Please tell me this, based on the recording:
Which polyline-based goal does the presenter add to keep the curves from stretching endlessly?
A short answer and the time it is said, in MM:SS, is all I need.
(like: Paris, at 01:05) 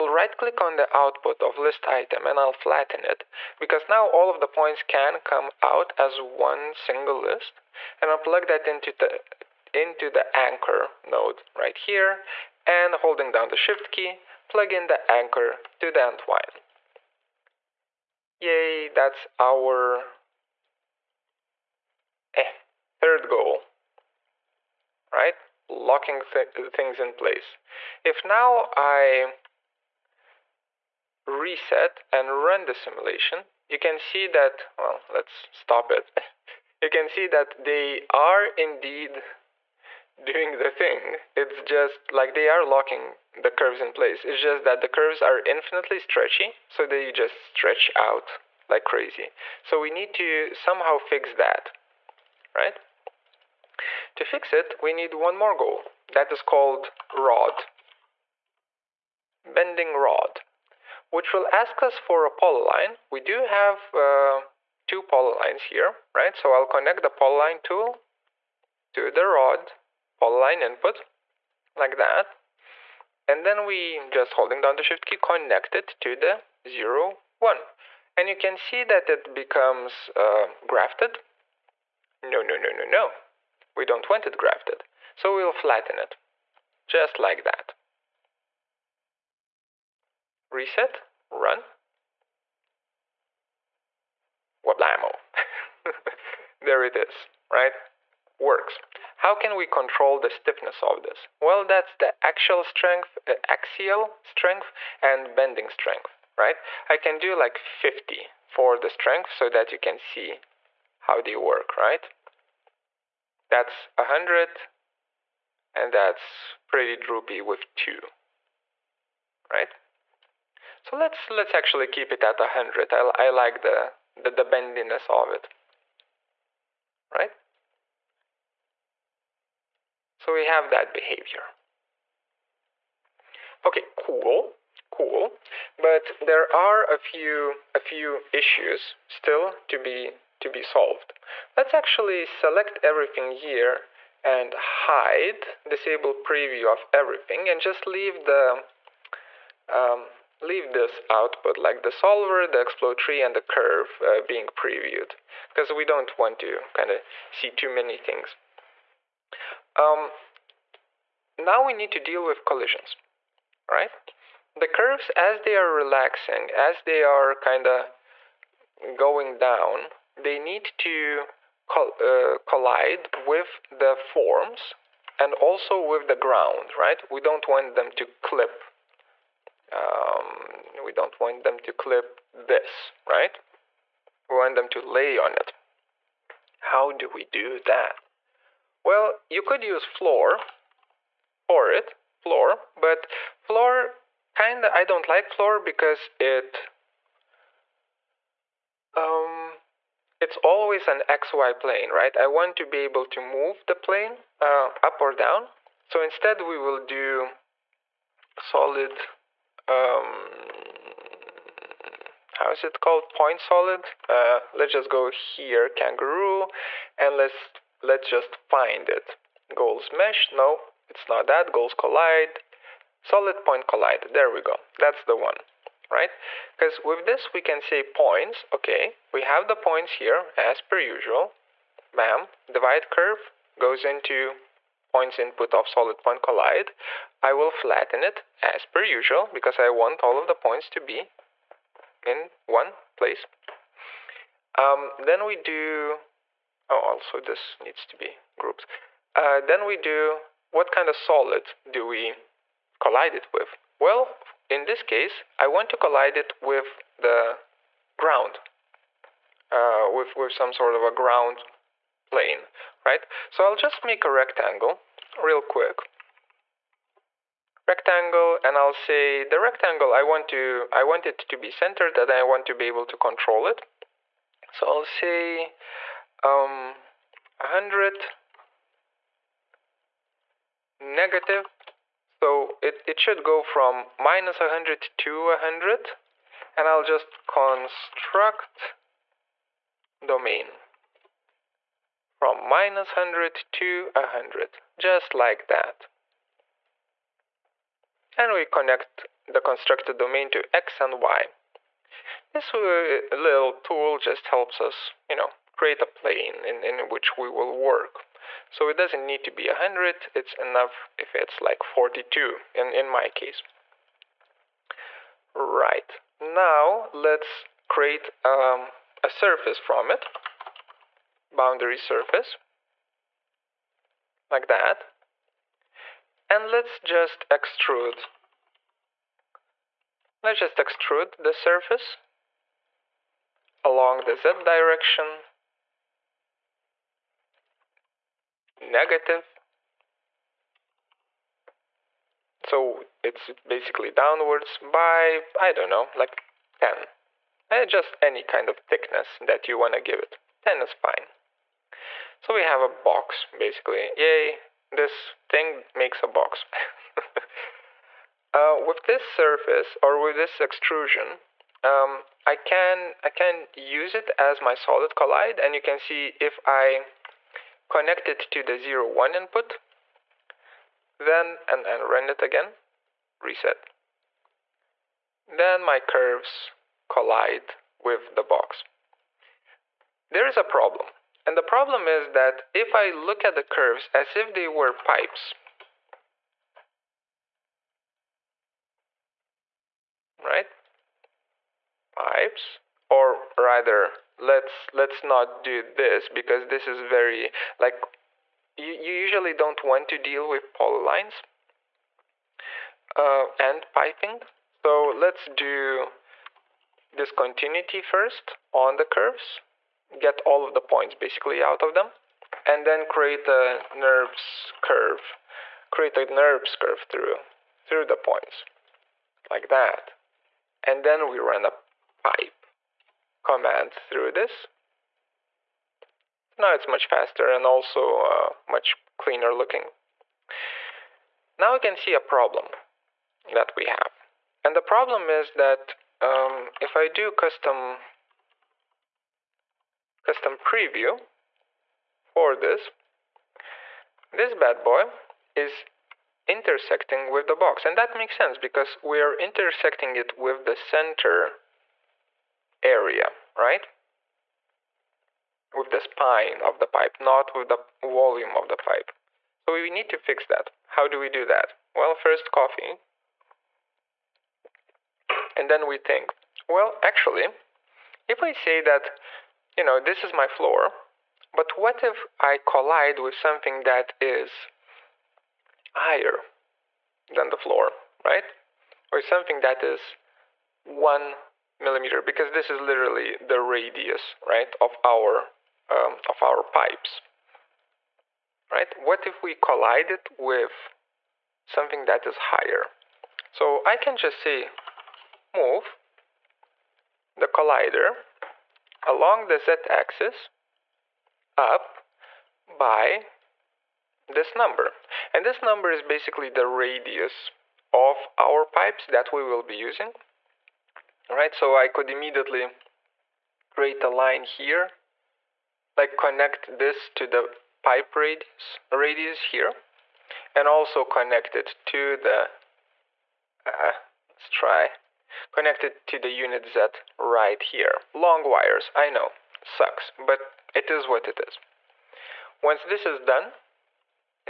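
bending rod, at 00:59.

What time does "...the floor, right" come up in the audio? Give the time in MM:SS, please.
07:57.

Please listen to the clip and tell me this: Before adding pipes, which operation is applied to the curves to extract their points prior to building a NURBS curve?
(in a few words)
discontinuity.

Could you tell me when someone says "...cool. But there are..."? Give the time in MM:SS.
02:14.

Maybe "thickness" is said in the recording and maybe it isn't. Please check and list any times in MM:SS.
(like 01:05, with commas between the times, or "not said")
05:48.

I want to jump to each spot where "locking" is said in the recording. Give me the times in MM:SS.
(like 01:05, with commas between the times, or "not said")
00:25, 00:42.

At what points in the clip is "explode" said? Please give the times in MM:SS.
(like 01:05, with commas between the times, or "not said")
02:32.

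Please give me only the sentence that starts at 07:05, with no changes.
So now it's much faster and also uh, much cleaner looking.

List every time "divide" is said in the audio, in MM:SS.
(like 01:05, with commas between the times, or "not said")
03:52.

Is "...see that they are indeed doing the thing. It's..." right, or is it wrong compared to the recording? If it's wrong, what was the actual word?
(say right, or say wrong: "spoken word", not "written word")
right.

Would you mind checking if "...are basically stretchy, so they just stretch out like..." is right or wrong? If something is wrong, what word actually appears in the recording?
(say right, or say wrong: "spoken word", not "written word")
wrong: "infinitely", not "basically".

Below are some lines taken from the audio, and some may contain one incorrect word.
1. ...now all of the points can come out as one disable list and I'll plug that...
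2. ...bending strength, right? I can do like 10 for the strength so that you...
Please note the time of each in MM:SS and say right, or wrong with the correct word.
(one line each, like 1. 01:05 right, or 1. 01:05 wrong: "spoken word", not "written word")
1. 00:03 wrong: "single", not "disable"
2. 01:45 wrong: "50", not "10".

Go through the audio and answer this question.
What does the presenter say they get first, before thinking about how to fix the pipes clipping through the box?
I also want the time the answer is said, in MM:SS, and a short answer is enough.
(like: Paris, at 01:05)
coffee, at 07:42.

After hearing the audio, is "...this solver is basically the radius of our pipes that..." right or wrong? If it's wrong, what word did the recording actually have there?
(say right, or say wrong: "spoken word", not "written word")
wrong: "number", not "solver".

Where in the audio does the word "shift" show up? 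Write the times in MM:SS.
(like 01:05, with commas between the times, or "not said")
00:13, 01:14.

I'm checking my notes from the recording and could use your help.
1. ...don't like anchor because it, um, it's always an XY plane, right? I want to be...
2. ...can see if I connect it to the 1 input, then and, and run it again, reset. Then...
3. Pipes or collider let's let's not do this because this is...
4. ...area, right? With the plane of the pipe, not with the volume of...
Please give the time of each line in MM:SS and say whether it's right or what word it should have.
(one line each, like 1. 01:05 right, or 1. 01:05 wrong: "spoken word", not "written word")
1. 03:14 wrong: "floor", not "anchor"
2. 06:05 right
3. 06:31 wrong: "rather", not "collider"
4. 07:32 wrong: "spine", not "plane".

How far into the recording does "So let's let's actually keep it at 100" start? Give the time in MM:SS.
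02:00.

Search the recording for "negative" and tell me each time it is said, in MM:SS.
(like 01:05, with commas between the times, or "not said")
04:40, 05:38.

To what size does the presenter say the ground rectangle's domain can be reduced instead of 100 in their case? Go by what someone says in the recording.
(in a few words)
42.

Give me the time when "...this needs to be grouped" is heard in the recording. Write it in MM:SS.
04:07.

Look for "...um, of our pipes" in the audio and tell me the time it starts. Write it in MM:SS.
08:05.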